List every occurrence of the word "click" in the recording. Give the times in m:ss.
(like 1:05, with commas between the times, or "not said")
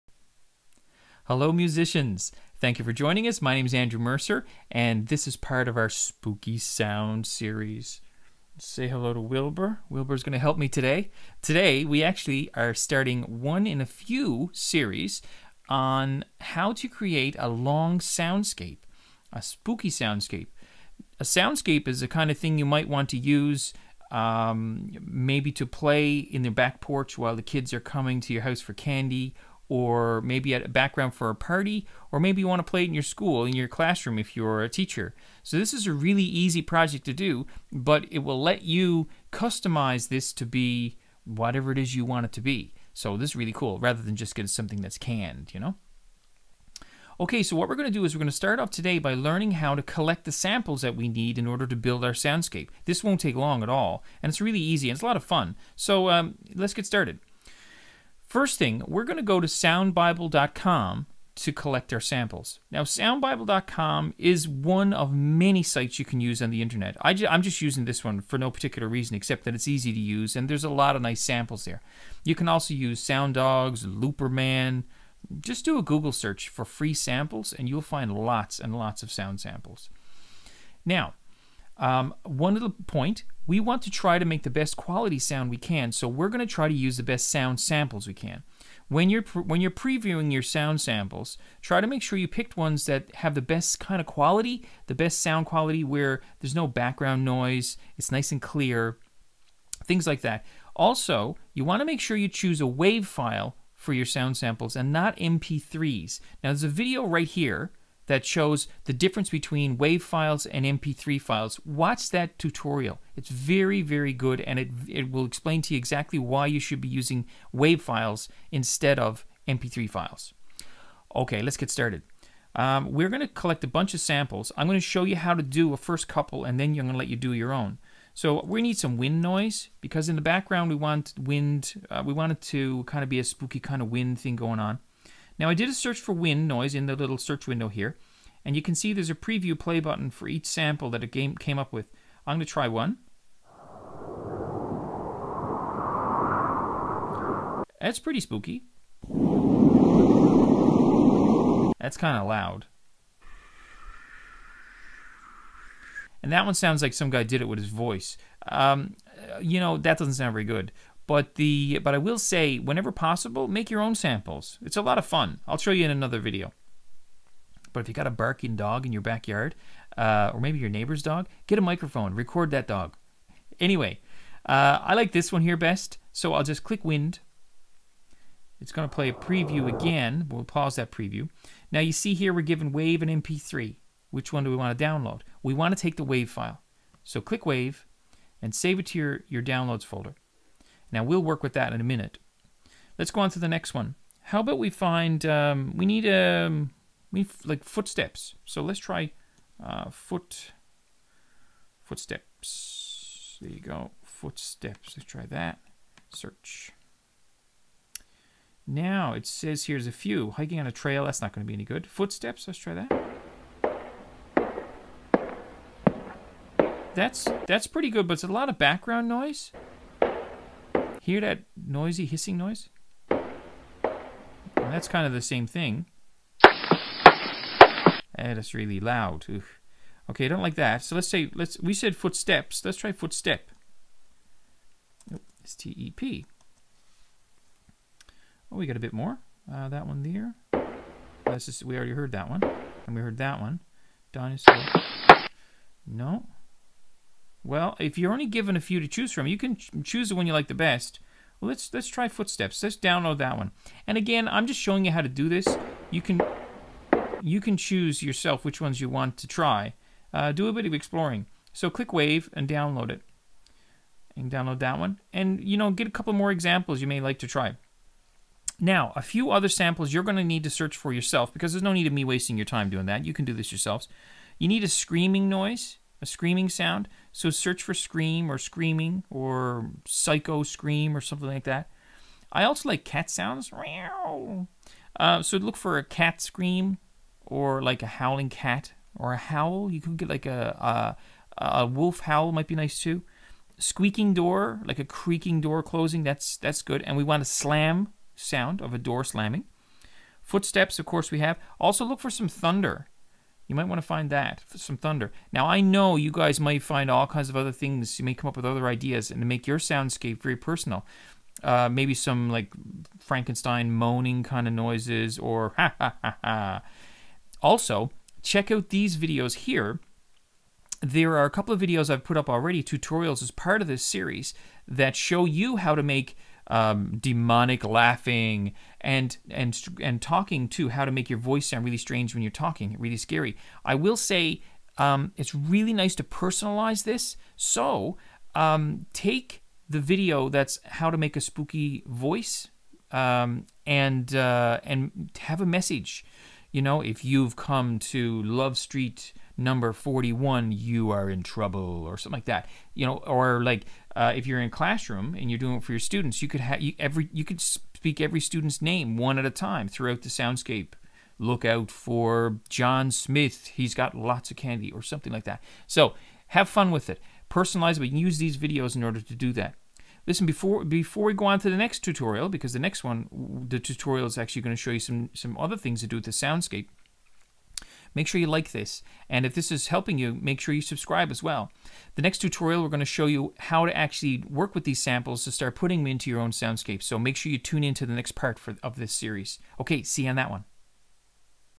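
2:56, 3:07, 4:21.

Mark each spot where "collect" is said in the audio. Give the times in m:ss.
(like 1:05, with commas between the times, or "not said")
0:49, 1:01, 2:03.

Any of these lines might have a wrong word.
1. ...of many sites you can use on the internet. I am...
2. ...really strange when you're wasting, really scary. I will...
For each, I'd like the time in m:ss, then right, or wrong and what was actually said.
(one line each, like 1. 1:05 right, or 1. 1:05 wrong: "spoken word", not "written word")
1. 1:04 right
2. 5:31 wrong: "talking", not "wasting".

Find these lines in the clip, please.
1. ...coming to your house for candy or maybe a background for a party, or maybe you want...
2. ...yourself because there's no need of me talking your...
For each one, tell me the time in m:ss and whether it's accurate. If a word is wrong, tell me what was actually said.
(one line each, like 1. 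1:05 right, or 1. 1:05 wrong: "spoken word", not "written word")
1. 0:27 right
2. 4:30 wrong: "wasting", not "talking".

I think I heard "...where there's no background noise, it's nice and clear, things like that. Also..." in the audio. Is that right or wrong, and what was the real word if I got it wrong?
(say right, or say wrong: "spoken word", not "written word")
right.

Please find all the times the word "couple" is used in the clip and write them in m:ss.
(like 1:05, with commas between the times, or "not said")
2:06, 4:25, 5:21.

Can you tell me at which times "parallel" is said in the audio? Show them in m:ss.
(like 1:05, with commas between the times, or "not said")
not said.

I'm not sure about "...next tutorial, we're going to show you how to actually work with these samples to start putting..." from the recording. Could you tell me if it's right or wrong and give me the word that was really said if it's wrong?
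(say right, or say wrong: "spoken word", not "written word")
right.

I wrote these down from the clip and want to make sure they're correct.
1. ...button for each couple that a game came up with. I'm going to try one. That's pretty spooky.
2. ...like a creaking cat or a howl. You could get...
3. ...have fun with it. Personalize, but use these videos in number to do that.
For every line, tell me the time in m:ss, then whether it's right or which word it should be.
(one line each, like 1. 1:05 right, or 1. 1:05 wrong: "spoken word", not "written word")
1. 2:19 wrong: "sample", not "couple"
2. 4:47 wrong: "howling", not "creaking"
3. 6:06 wrong: "order", not "number".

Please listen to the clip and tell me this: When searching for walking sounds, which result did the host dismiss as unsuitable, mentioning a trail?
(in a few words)
Hiking on a trail.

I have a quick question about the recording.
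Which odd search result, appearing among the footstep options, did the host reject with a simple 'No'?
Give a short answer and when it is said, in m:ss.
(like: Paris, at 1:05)
Dinosaur, at 4:04.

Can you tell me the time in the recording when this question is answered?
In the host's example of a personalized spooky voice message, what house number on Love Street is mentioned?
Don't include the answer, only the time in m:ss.
5:49.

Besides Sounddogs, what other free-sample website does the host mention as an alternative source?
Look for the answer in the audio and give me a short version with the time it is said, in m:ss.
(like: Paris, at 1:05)
Looperman, at 1:13.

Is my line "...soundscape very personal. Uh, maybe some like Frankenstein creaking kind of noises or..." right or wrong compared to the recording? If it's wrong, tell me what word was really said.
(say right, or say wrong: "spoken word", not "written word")
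wrong: "moaning", not "creaking".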